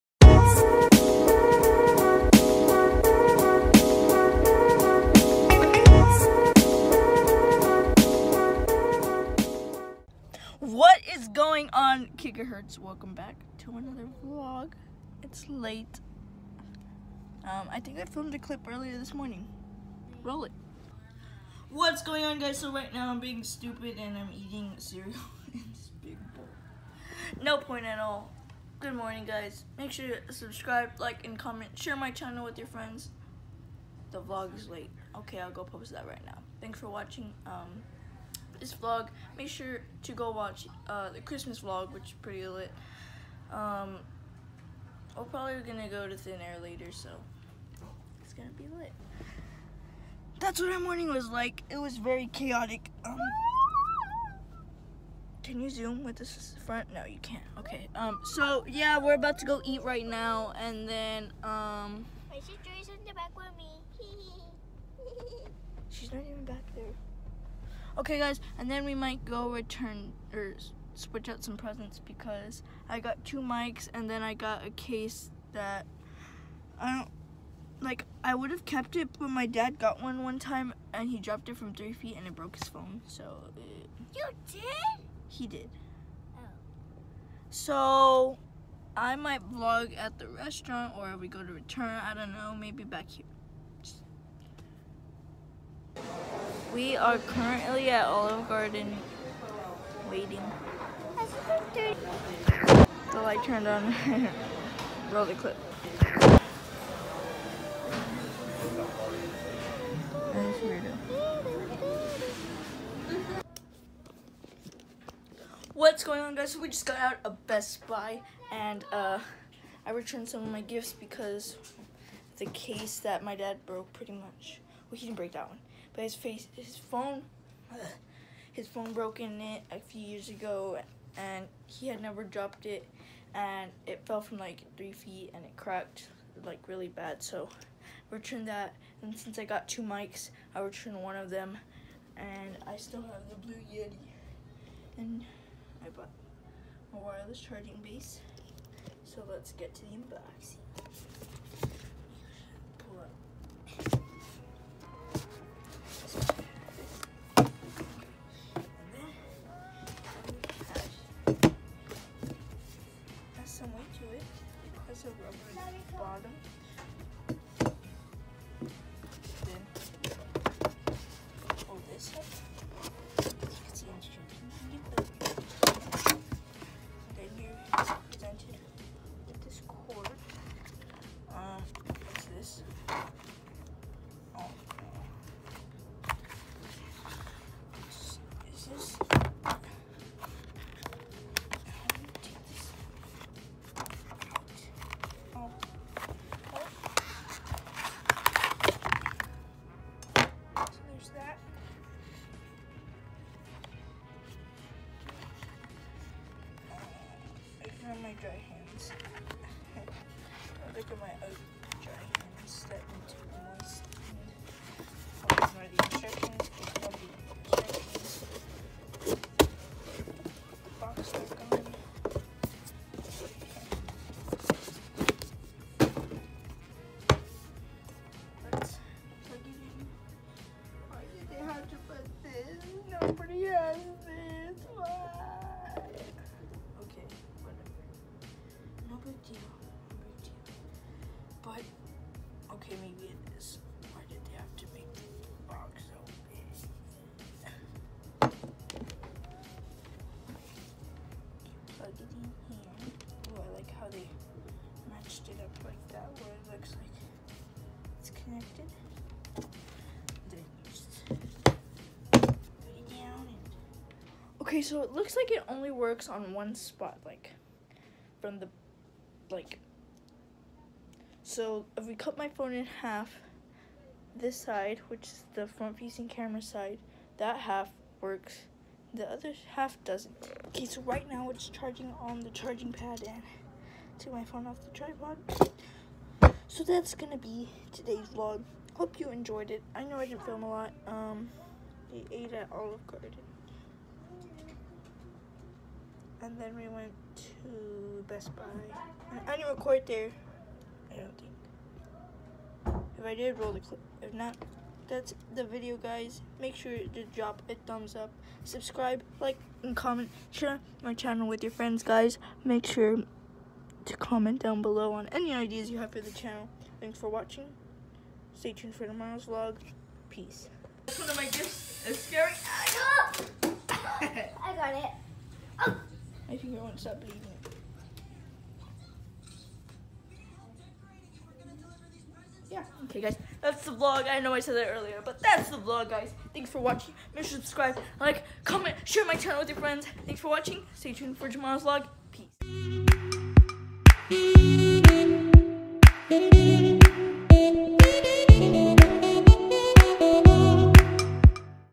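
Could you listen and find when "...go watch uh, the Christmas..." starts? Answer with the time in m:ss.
0:40.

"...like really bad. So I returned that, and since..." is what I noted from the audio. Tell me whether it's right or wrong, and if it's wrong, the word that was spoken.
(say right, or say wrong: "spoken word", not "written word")
right.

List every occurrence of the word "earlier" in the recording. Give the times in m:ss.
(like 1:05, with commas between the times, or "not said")
0:18, 5:34.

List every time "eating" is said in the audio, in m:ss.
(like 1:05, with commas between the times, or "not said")
0:24.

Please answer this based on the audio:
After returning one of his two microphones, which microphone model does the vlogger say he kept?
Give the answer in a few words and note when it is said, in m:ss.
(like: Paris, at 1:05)
Blue Yeti, at 2:23.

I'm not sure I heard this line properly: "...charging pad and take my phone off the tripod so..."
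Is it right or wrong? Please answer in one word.
right.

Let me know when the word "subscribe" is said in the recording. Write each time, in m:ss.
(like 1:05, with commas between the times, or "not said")
0:30, 5:08, 5:37.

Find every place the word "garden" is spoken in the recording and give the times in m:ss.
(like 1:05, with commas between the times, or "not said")
1:38, 4:52.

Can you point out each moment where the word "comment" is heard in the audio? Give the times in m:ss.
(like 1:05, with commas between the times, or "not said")
0:31, 5:09, 5:13, 5:38.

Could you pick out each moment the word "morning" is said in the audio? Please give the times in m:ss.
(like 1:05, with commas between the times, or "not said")
0:19, 0:28, 0:50.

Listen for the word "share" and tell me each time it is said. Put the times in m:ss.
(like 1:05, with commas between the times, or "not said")
0:31, 5:10, 5:38.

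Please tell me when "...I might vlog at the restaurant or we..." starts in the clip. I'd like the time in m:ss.
1:28.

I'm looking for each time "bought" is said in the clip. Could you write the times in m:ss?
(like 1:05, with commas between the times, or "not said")
2:25.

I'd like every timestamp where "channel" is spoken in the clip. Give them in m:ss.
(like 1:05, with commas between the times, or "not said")
0:32, 5:10, 5:16, 5:39.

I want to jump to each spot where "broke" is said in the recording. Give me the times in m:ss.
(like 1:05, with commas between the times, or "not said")
1:22, 2:03, 2:08.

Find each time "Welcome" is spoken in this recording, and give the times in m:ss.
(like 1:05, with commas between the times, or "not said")
0:12.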